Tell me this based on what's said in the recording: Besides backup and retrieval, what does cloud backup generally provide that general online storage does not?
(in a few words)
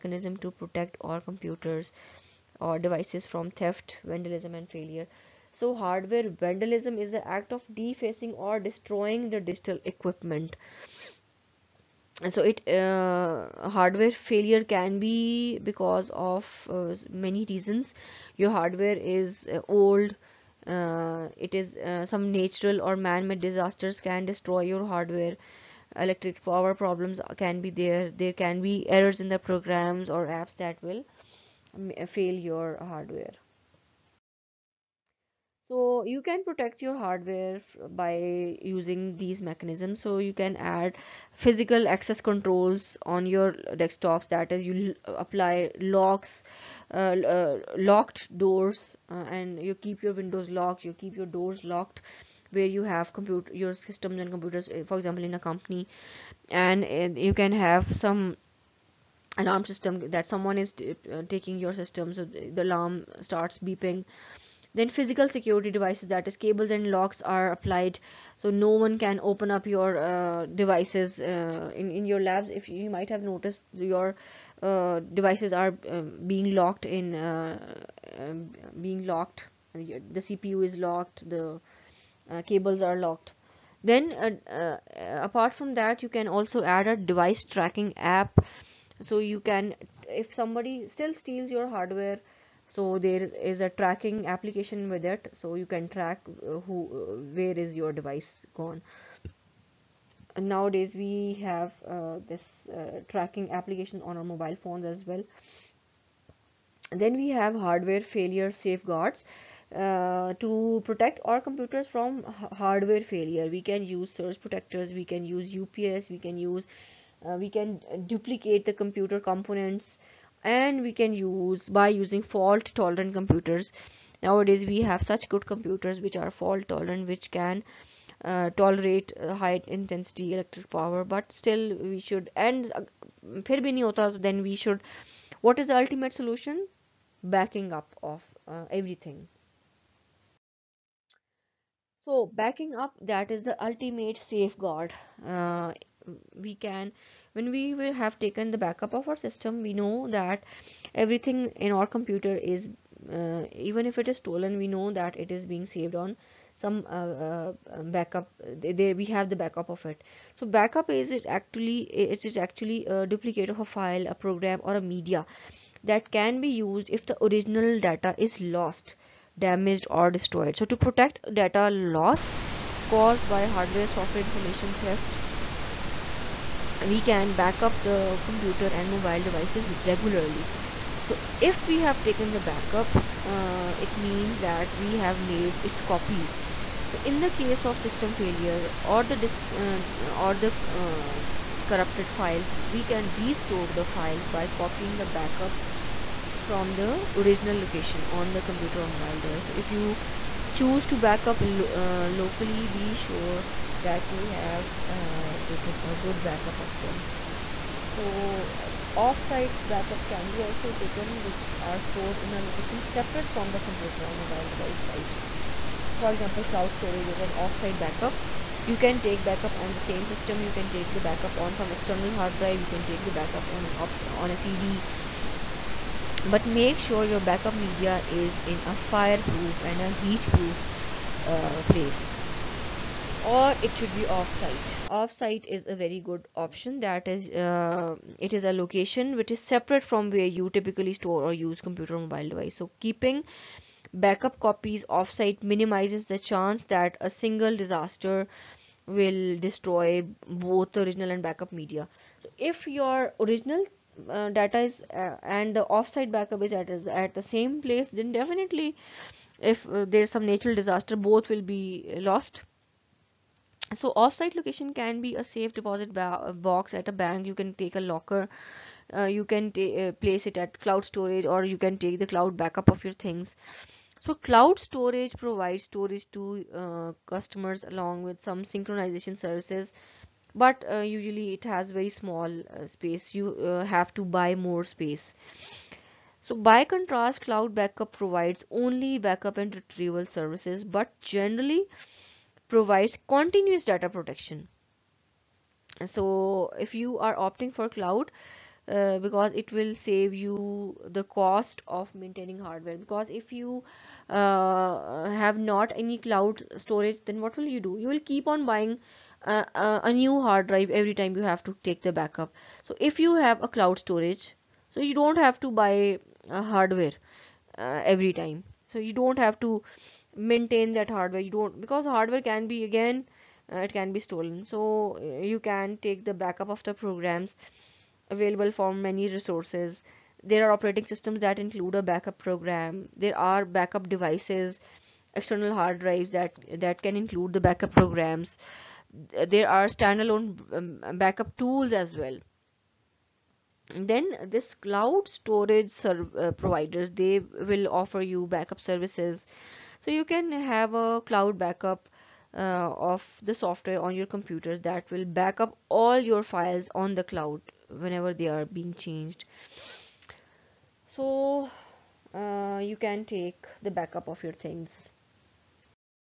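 continuous data protection.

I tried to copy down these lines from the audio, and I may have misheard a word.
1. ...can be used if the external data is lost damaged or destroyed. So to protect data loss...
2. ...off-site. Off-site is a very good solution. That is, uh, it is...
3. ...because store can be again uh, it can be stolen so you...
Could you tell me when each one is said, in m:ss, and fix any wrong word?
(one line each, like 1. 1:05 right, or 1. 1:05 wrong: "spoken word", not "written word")
1. 2:46 wrong: "original", not "external"
2. 3:54 wrong: "option", not "solution"
3. 5:21 wrong: "hardware", not "store".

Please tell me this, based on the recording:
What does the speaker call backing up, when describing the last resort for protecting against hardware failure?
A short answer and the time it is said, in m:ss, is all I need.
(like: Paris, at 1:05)
the ultimate safeguard, at 2:23.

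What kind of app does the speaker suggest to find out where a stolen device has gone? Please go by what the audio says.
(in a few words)
device tracking app.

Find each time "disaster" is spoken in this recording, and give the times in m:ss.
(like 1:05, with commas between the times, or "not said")
0:23, 4:07, 4:20.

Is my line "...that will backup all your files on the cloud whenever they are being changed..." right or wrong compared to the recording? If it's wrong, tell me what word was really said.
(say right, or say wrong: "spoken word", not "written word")
right.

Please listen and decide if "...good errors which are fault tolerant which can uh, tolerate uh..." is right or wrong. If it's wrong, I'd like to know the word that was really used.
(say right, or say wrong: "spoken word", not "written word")
wrong: "computers", not "errors".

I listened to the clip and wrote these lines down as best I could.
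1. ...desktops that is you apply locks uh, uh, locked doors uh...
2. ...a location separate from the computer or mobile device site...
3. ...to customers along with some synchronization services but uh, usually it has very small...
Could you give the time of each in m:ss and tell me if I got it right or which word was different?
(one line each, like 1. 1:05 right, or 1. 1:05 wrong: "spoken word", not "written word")
1. 0:43 right
2. 3:32 right
3. 4:36 right.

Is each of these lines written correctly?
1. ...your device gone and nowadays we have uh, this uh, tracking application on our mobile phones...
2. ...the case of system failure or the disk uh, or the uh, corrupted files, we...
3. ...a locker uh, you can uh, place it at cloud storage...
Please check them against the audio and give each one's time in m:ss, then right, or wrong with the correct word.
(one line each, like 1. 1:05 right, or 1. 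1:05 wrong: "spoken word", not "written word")
1. 1:37 right
2. 3:07 right
3. 4:27 right.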